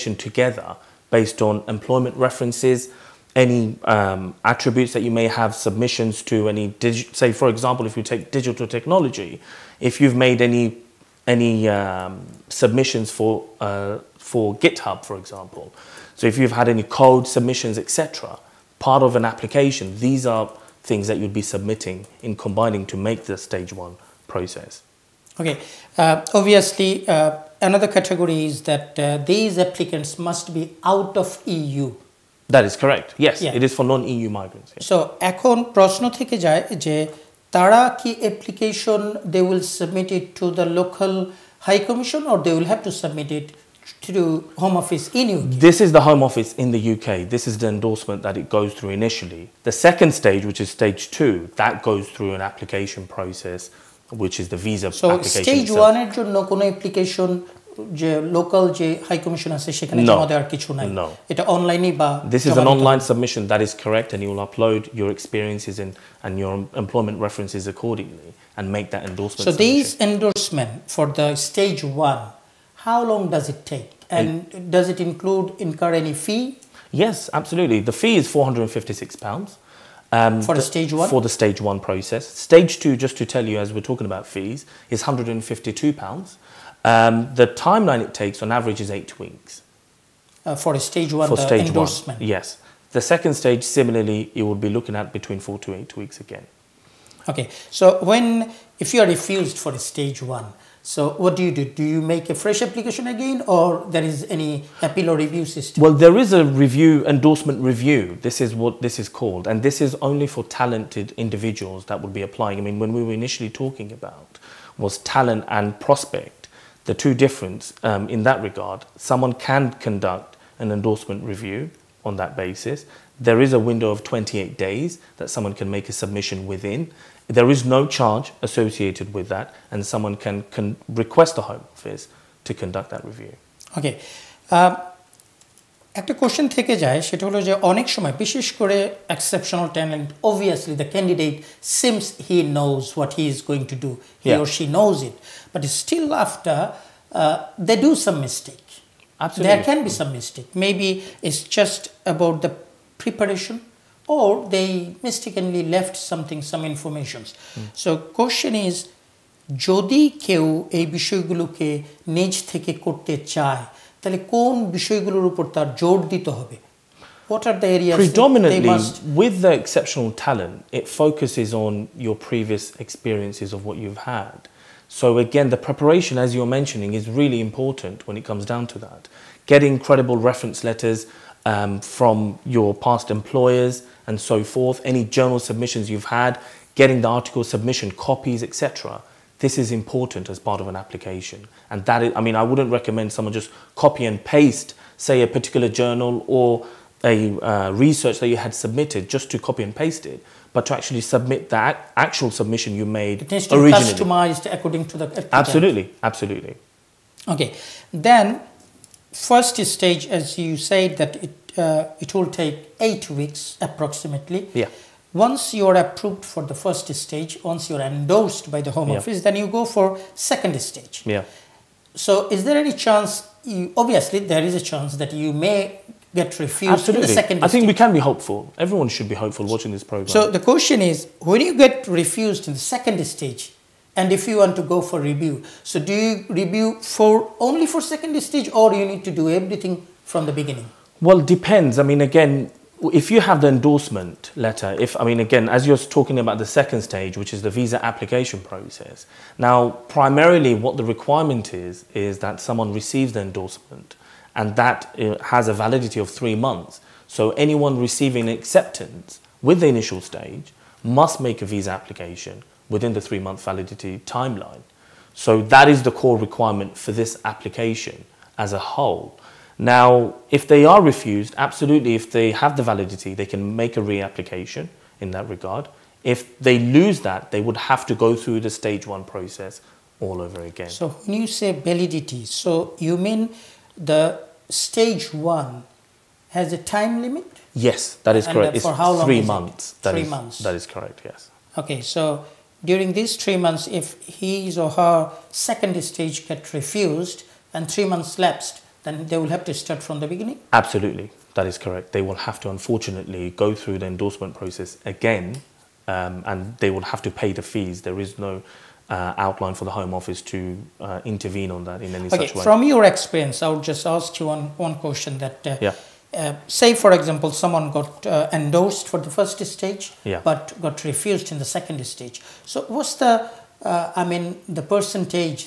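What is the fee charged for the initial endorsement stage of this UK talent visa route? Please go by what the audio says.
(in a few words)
£456.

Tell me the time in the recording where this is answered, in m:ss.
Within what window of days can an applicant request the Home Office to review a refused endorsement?
2:04.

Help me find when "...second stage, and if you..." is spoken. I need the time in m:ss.
3:52.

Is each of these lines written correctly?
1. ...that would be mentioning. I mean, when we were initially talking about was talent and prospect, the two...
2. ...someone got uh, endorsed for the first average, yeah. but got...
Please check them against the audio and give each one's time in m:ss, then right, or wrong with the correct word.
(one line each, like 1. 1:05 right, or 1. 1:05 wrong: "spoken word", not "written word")
1. 1:51 wrong: "applying", not "mentioning"
2. 5:17 wrong: "stage", not "average".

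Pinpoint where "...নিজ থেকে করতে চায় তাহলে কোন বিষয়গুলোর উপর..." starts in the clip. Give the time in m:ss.
2:42.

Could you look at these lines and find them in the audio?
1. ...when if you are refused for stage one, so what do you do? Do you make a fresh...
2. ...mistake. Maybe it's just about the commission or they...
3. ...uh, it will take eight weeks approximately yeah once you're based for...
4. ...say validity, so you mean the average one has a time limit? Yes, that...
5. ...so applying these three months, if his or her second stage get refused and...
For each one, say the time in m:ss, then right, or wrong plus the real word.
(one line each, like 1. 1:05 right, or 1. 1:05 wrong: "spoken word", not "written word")
1. 1:38 right
2. 2:30 wrong: "preparation", not "commission"
3. 3:31 wrong: "approved", not "based"
4. 4:41 wrong: "stage", not "average"
5. 4:51 wrong: "during", not "applying".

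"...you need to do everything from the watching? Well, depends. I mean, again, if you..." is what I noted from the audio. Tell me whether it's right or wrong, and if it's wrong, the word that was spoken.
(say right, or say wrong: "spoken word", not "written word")
wrong: "beginning", not "watching".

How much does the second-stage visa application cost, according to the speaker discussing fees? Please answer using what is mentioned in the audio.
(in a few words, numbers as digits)
£152.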